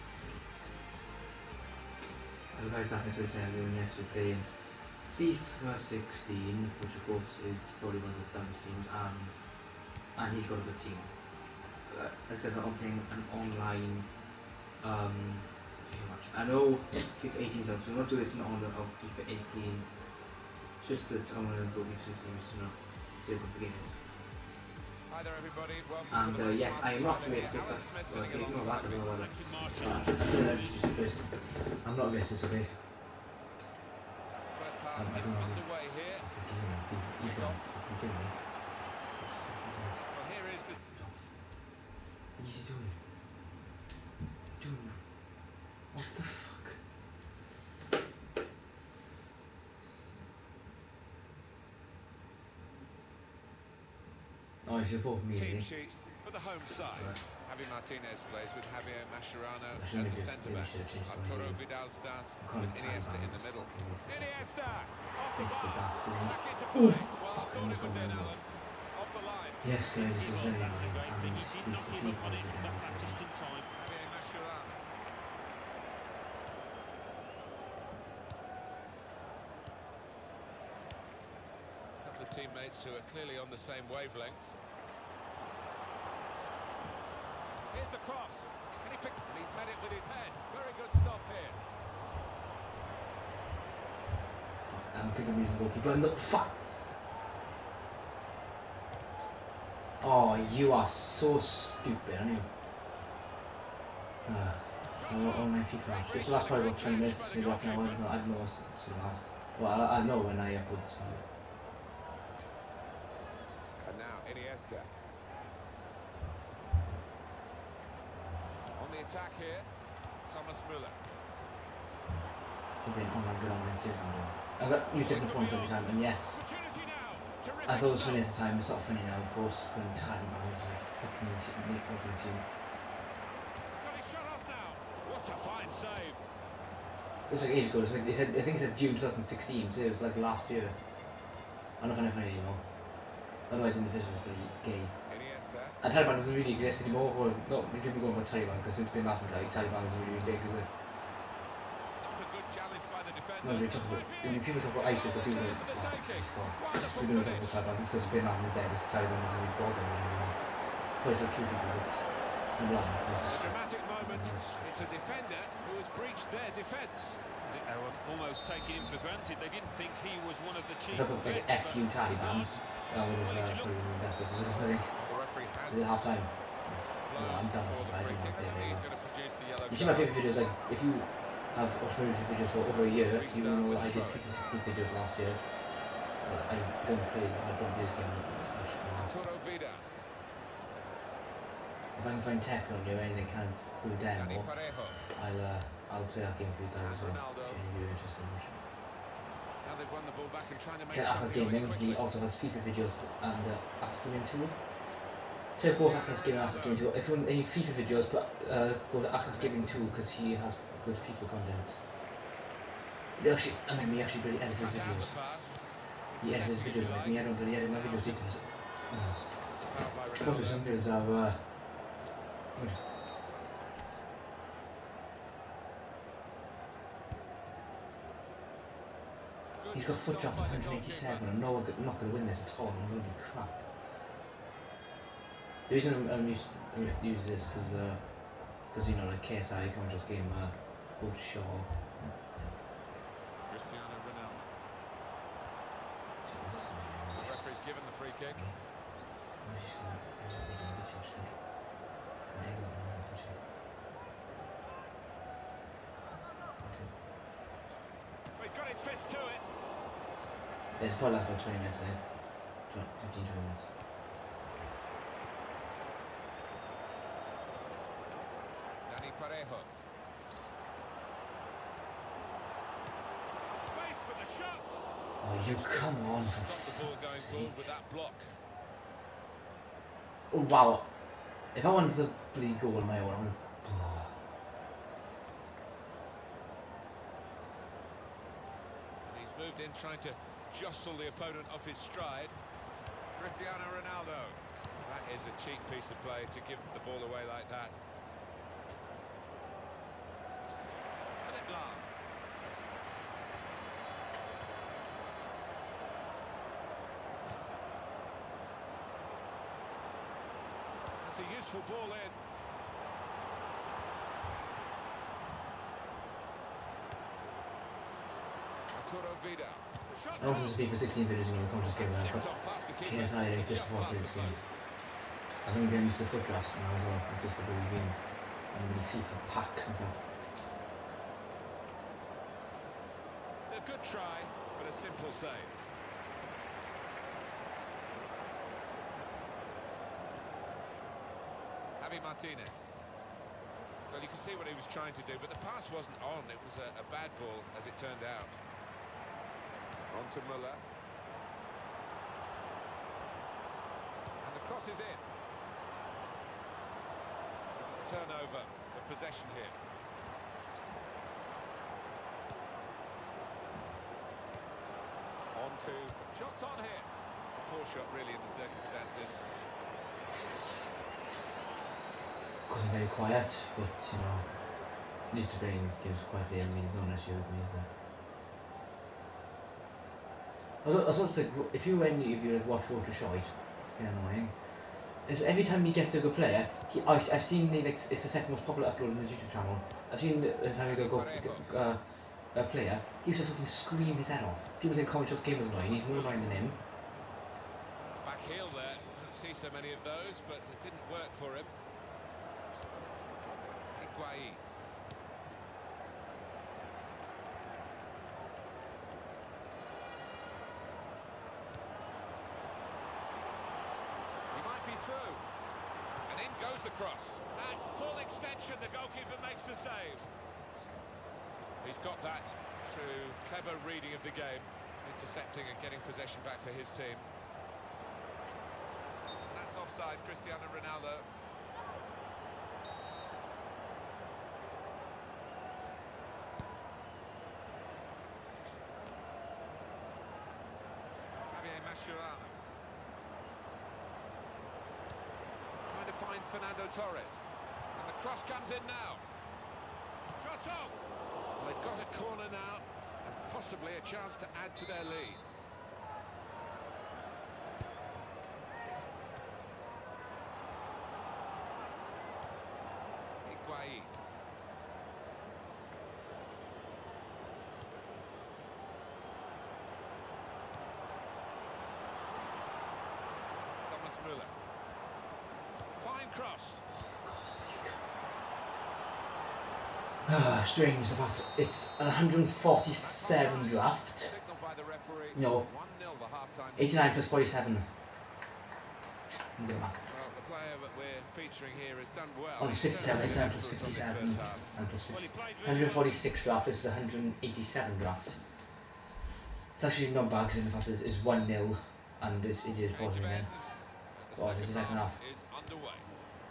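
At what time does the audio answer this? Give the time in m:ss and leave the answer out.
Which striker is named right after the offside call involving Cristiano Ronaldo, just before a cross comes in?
7:26.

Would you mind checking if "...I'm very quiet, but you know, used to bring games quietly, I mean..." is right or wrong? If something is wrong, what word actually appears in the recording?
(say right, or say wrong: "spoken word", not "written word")
right.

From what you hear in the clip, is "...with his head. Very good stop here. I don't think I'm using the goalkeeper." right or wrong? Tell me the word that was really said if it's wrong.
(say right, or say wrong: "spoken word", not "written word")
right.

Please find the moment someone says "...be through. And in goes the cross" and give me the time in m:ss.
6:54.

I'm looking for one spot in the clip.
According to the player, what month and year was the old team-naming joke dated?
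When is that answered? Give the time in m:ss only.
2:18.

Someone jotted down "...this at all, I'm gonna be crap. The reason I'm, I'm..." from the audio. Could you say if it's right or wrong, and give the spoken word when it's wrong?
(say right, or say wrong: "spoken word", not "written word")
right.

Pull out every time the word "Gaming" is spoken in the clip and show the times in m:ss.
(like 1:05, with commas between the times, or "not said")
3:21.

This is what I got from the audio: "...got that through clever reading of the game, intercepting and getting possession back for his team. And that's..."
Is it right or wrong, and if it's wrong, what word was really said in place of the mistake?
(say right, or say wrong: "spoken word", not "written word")
right.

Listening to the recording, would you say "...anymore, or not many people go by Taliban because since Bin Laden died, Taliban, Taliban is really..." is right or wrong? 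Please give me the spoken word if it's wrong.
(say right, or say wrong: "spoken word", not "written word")
right.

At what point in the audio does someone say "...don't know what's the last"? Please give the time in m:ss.
1:48.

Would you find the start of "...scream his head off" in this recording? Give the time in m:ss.
6:33.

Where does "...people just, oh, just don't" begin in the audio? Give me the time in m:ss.
2:35.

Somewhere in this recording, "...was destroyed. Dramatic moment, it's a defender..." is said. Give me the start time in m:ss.
2:42.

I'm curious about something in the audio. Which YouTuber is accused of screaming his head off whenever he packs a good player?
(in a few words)
Wroetoshaw.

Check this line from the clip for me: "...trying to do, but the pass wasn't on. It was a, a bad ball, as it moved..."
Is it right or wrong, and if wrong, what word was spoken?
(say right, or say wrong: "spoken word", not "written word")
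wrong: "turned", not "moved".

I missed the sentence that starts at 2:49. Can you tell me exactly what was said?
They didn't think he was one of the chief.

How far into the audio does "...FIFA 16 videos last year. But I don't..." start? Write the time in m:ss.
3:04.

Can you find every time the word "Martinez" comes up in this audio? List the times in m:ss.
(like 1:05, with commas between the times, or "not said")
0:57, 5:42.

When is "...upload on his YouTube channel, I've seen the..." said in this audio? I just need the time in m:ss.
6:28.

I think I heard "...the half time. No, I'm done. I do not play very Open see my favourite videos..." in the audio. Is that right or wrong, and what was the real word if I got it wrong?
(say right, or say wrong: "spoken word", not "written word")
wrong: "You", not "Open".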